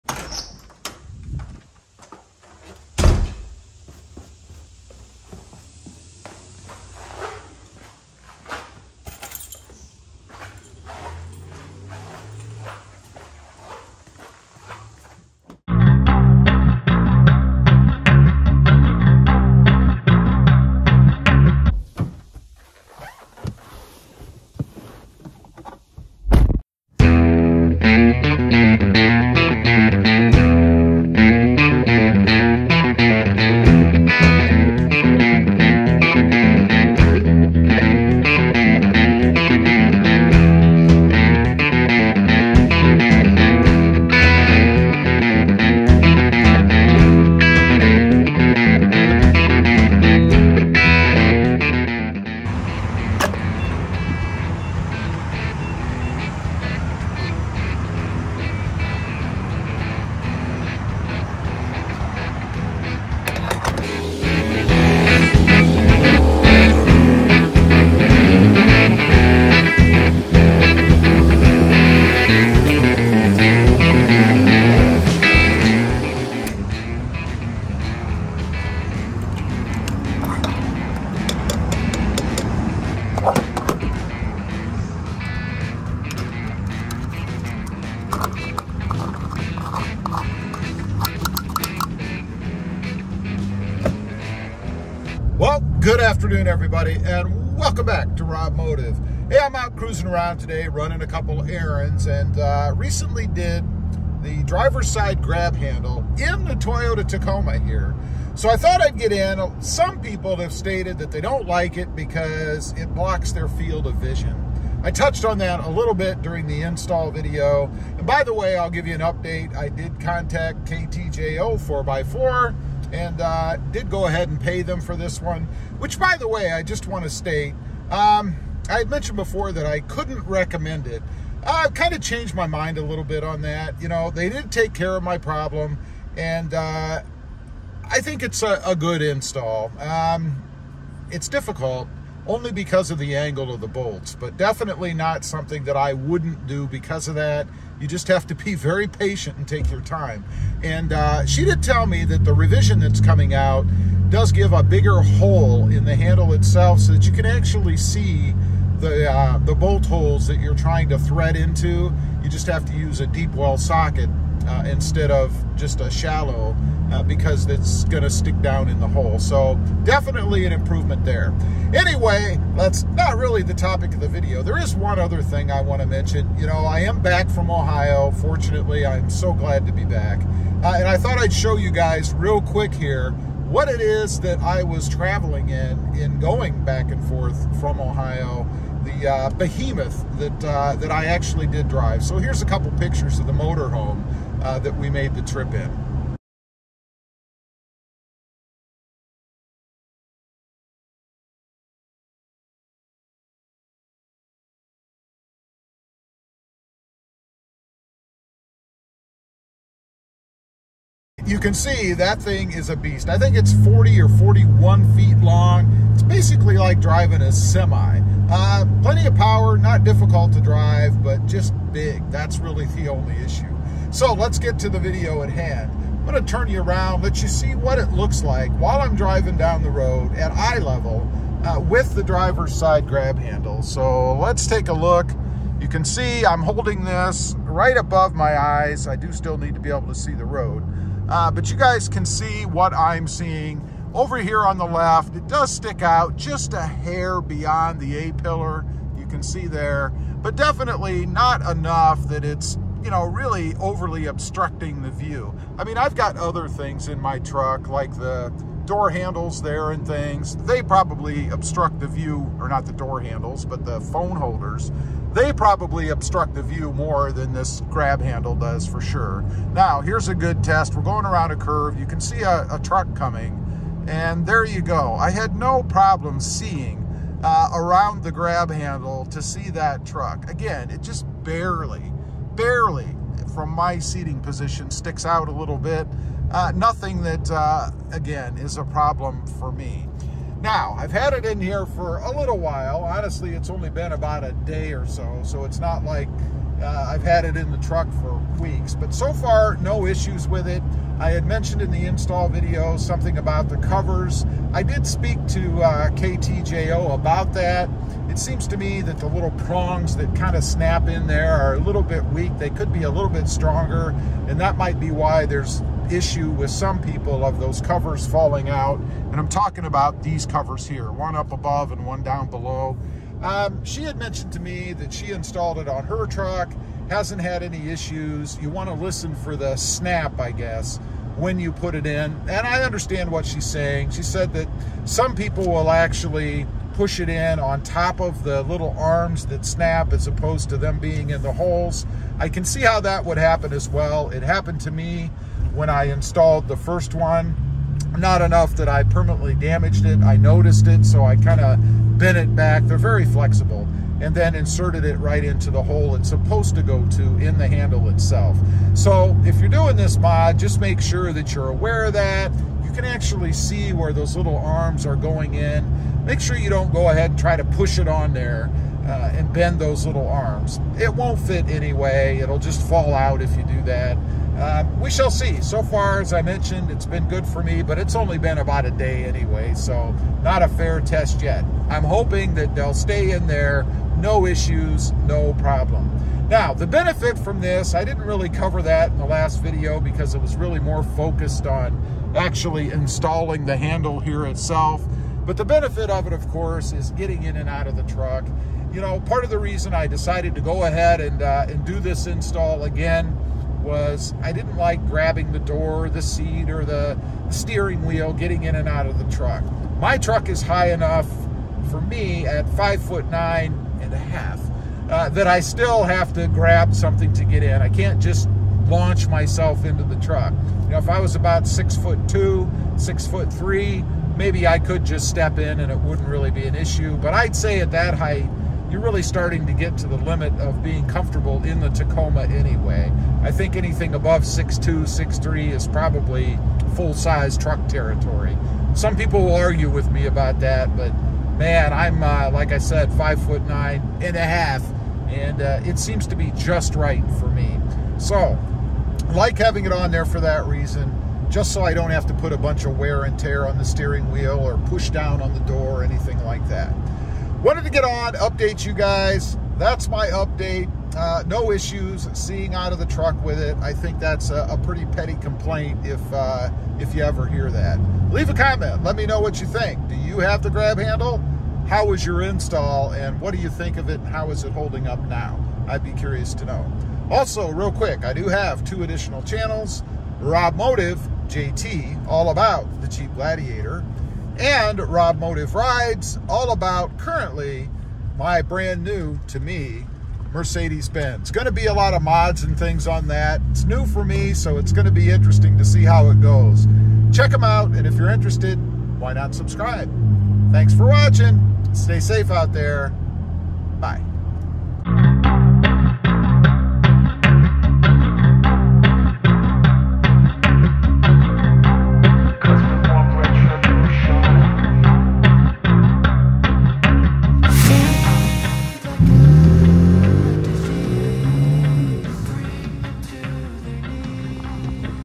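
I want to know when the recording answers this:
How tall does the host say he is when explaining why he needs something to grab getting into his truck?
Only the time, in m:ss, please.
6:52.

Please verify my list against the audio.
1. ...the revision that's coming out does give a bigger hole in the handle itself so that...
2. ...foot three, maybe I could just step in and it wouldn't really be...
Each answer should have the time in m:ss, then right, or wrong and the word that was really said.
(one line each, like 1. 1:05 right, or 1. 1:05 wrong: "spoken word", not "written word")
1. 2:32 right
2. 7:03 right.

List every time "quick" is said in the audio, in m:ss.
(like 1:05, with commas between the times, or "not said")
3:02, 7:57.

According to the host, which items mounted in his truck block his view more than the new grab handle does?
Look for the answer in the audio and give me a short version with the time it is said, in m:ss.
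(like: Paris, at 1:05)
Phone holders, at 4:23.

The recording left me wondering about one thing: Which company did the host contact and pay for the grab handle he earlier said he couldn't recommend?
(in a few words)
KTJO 4x4.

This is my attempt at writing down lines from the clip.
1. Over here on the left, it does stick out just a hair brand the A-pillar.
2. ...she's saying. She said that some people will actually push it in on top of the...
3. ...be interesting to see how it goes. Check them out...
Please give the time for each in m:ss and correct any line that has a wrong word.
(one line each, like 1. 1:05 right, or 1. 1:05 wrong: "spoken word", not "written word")
1. 4:03 wrong: "beyond", not "brand"
2. 5:33 right
3. 8:14 right.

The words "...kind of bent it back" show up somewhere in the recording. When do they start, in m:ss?
5:51.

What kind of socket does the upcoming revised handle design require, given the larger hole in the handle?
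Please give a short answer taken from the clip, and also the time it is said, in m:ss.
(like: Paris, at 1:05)
Deep well socket, at 2:43.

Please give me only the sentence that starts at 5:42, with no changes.
I can see how that would happen as well.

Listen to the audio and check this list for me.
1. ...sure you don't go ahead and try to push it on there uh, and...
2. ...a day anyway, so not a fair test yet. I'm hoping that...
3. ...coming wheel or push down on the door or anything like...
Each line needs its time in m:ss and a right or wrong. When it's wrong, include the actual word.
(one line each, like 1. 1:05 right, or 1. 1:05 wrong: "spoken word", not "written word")
1. 6:06 right
2. 6:18 right
3. 7:33 wrong: "steering", not "coming".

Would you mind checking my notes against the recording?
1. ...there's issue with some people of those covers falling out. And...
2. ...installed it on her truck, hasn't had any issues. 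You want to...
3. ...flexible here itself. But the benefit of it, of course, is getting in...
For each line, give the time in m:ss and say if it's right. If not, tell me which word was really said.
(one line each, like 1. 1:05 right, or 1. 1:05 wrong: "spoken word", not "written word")
1. 5:15 right
2. 5:25 right
3. 6:33 wrong: "handle", not "flexible".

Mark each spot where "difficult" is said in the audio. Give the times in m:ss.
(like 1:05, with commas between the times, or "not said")
2:21, 3:39.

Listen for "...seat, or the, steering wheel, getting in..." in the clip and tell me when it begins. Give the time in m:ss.
6:46.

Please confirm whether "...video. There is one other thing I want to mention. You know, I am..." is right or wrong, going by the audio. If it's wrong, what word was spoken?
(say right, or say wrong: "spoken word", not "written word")
right.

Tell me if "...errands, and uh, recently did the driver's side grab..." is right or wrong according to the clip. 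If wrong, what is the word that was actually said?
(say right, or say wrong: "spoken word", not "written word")
right.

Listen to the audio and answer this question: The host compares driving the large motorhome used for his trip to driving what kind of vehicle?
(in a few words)
A semi.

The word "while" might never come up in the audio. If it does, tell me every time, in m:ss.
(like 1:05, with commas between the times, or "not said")
3:48, 4:52.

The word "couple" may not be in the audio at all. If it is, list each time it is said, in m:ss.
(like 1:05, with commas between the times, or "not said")
1:41, 3:12.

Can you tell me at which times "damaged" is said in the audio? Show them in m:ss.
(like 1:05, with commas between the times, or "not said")
5:49.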